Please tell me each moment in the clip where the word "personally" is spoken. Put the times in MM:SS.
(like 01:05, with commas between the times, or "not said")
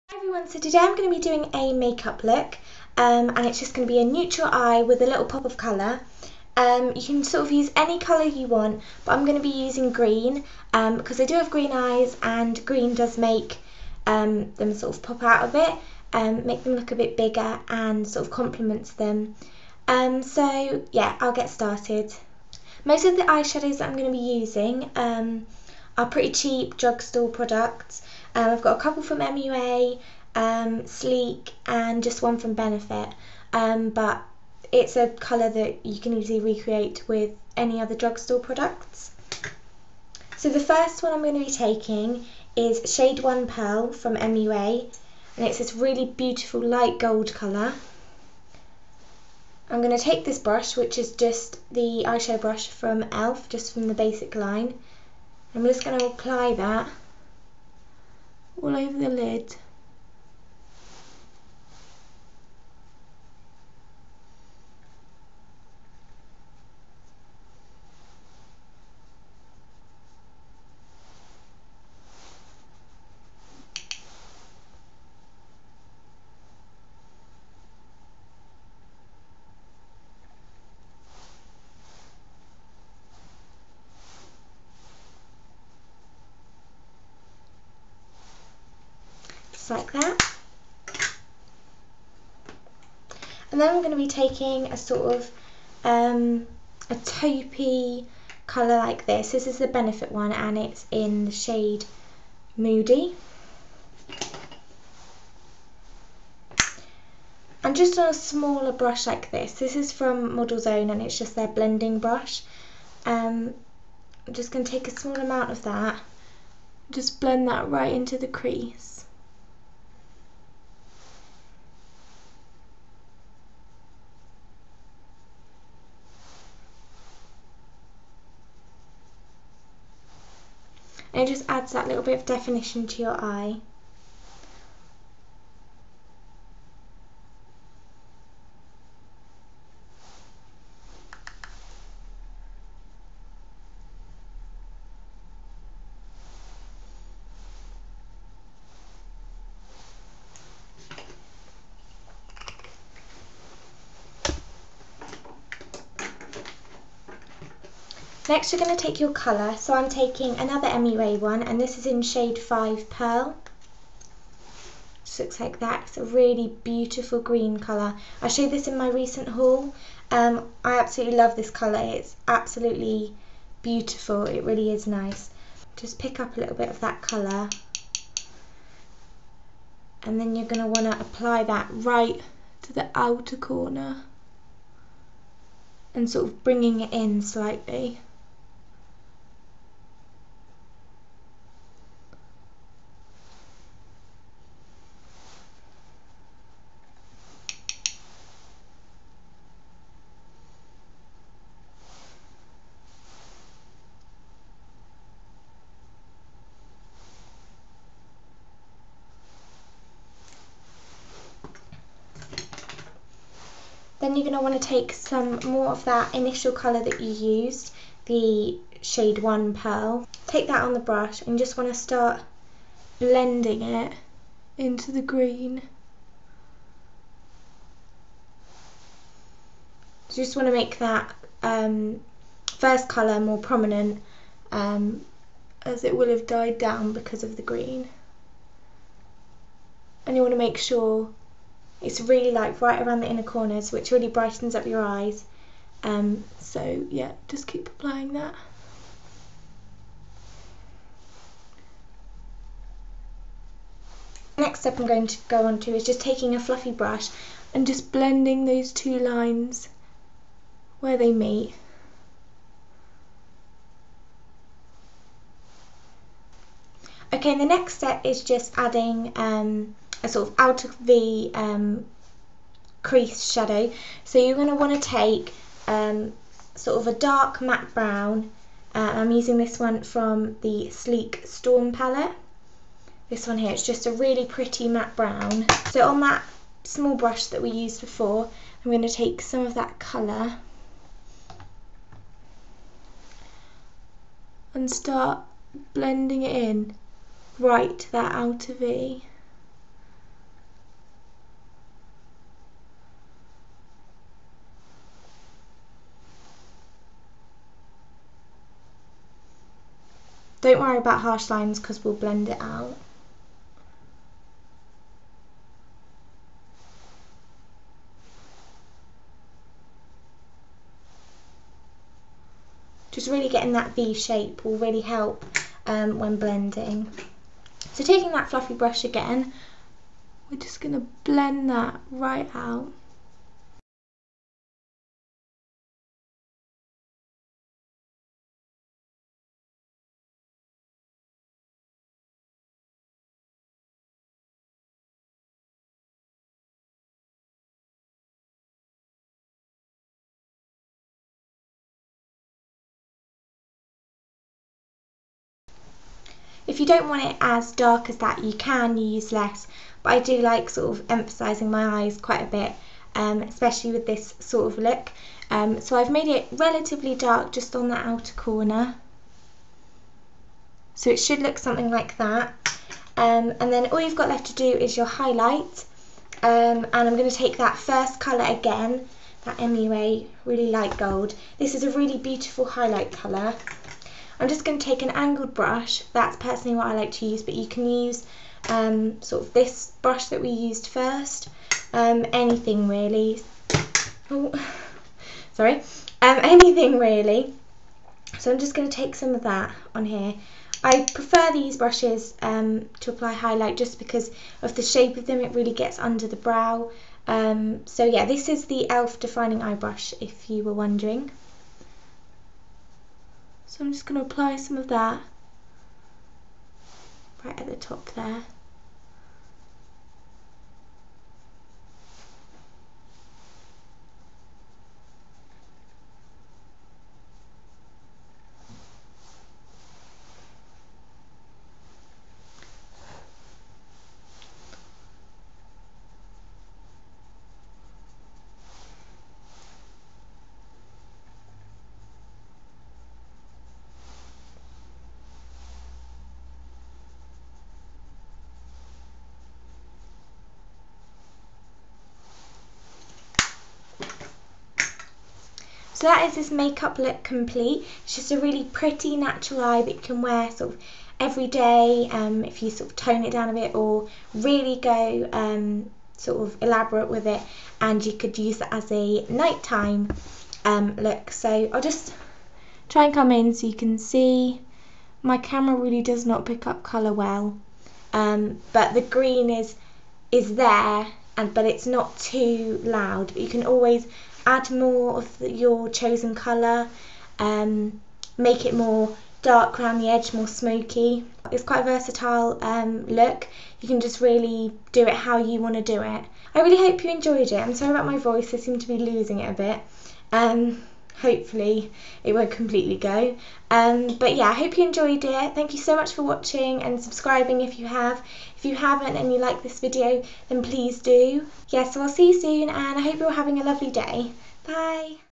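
06:26.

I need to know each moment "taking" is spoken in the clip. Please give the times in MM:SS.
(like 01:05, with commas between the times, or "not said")
00:41, 01:34, 02:39, 04:16, 05:27.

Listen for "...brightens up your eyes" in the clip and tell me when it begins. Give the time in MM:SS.
04:04.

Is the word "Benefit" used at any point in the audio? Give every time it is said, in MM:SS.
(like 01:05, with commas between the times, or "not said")
00:32, 01:39.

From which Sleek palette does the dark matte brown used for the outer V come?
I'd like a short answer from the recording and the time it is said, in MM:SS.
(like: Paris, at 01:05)
Storm, at 04:40.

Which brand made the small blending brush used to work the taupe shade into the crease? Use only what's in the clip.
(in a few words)
Models Own.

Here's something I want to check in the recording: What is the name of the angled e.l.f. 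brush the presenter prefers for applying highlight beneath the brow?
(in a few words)
Defining Eye Brush.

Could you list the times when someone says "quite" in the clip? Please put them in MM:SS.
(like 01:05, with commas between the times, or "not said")
06:01, 08:11.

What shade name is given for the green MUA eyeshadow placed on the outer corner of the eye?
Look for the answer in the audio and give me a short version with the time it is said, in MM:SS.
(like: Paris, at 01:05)
Shade 5 Pearl, at 02:42.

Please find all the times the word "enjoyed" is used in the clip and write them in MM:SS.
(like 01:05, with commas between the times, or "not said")
08:16, 08:24.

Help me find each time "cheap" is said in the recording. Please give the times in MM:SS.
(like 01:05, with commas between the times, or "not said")
00:26.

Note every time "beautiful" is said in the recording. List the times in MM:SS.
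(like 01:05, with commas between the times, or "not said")
00:46, 02:46, 02:53, 06:21.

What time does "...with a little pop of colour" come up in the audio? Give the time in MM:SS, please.
00:04.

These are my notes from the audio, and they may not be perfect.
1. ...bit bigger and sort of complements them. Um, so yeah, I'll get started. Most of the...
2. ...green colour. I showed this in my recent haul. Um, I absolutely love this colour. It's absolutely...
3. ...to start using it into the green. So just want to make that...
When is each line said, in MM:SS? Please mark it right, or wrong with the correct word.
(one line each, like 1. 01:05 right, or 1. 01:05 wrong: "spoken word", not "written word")
1. 00:16 right
2. 02:47 right
3. 03:41 wrong: "blending", not "using".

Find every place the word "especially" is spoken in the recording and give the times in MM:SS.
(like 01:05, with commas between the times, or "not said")
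06:03.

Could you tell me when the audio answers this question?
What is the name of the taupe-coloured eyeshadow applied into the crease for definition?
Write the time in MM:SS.
01:42.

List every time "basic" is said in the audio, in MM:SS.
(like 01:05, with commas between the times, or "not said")
00:53.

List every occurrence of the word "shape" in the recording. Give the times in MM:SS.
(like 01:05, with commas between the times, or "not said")
05:23, 06:44.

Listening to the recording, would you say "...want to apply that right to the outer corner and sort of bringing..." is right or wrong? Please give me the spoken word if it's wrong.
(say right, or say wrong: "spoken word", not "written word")
right.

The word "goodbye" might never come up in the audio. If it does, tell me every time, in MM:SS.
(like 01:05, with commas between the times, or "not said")
not said.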